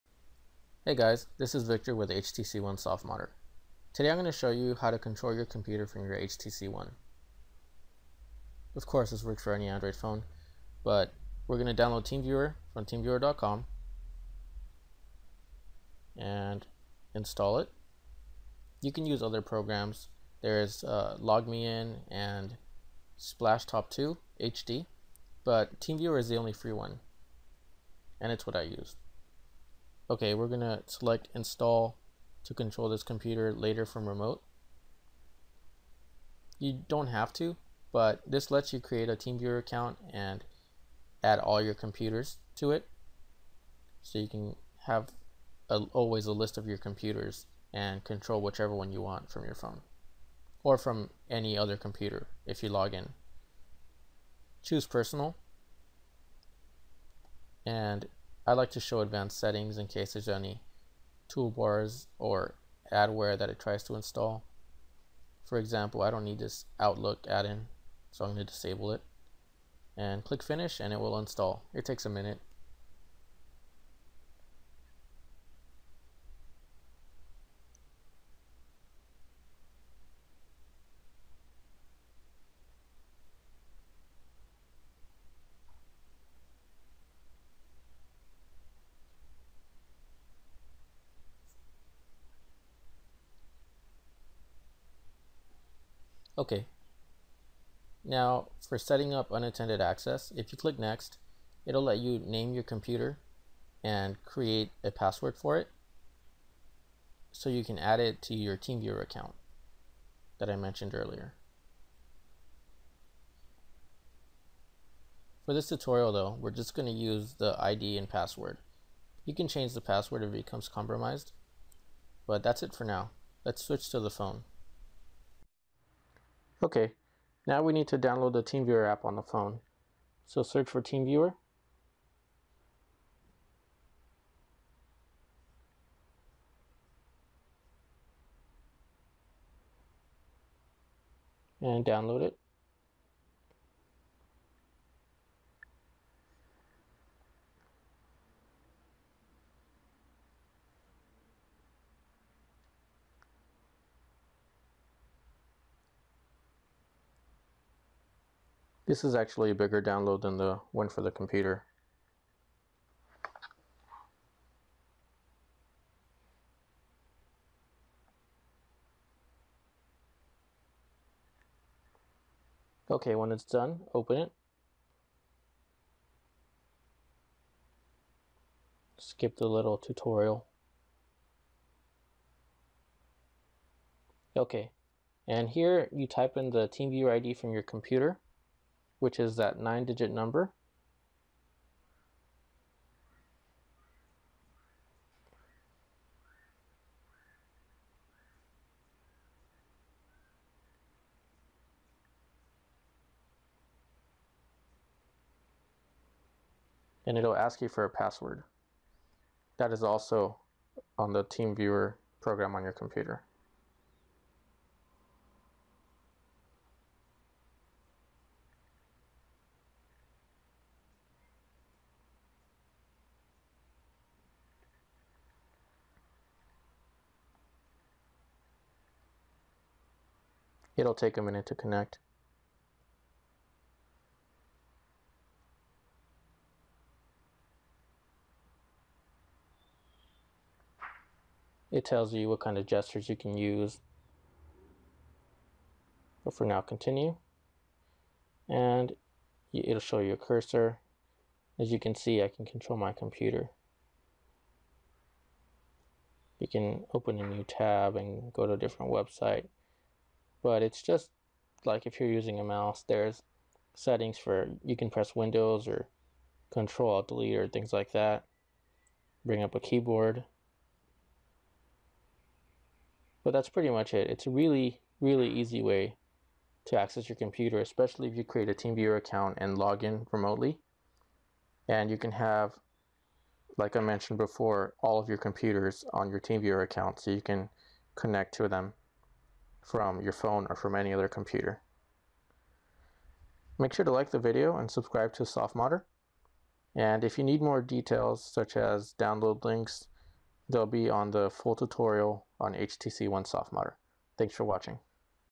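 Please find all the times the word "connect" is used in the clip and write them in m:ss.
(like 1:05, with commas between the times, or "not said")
3:51, 4:47.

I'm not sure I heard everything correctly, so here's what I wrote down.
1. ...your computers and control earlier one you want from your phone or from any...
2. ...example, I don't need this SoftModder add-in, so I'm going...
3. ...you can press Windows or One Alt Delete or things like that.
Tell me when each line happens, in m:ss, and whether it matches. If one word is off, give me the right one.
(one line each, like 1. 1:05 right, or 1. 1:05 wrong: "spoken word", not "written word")
1. 0:46 wrong: "whichever", not "earlier"
2. 1:05 wrong: "Outlook", not "SoftModder"
3. 4:24 wrong: "Control", not "One".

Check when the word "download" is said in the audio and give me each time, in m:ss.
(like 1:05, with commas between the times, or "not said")
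0:11, 2:07, 2:21, 2:39, 4:58.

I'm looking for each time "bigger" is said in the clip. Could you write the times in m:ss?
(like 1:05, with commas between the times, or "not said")
2:39.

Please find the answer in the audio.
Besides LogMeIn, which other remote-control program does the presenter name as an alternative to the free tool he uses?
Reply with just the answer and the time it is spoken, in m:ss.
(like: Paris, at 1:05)
SplashTop 2 HD, at 0:23.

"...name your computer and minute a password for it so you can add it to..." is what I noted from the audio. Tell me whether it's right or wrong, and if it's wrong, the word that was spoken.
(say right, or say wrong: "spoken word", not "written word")
wrong: "create", not "minute".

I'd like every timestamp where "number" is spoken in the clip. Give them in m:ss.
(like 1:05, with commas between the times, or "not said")
3:10.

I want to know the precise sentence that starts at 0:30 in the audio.
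Okay, we're going to select install to control this computer later from remote.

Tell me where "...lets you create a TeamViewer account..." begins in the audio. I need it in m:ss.
0:38.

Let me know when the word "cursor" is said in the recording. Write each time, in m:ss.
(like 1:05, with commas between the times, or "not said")
4:10.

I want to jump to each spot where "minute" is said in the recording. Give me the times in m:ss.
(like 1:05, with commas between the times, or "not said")
1:12, 3:51.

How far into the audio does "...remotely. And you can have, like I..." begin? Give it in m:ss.
4:40.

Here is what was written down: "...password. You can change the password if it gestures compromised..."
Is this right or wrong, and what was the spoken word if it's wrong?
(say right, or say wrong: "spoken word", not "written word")
wrong: "becomes", not "gestures".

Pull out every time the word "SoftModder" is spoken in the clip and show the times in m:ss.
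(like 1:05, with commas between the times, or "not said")
0:02, 4:55, 5:03.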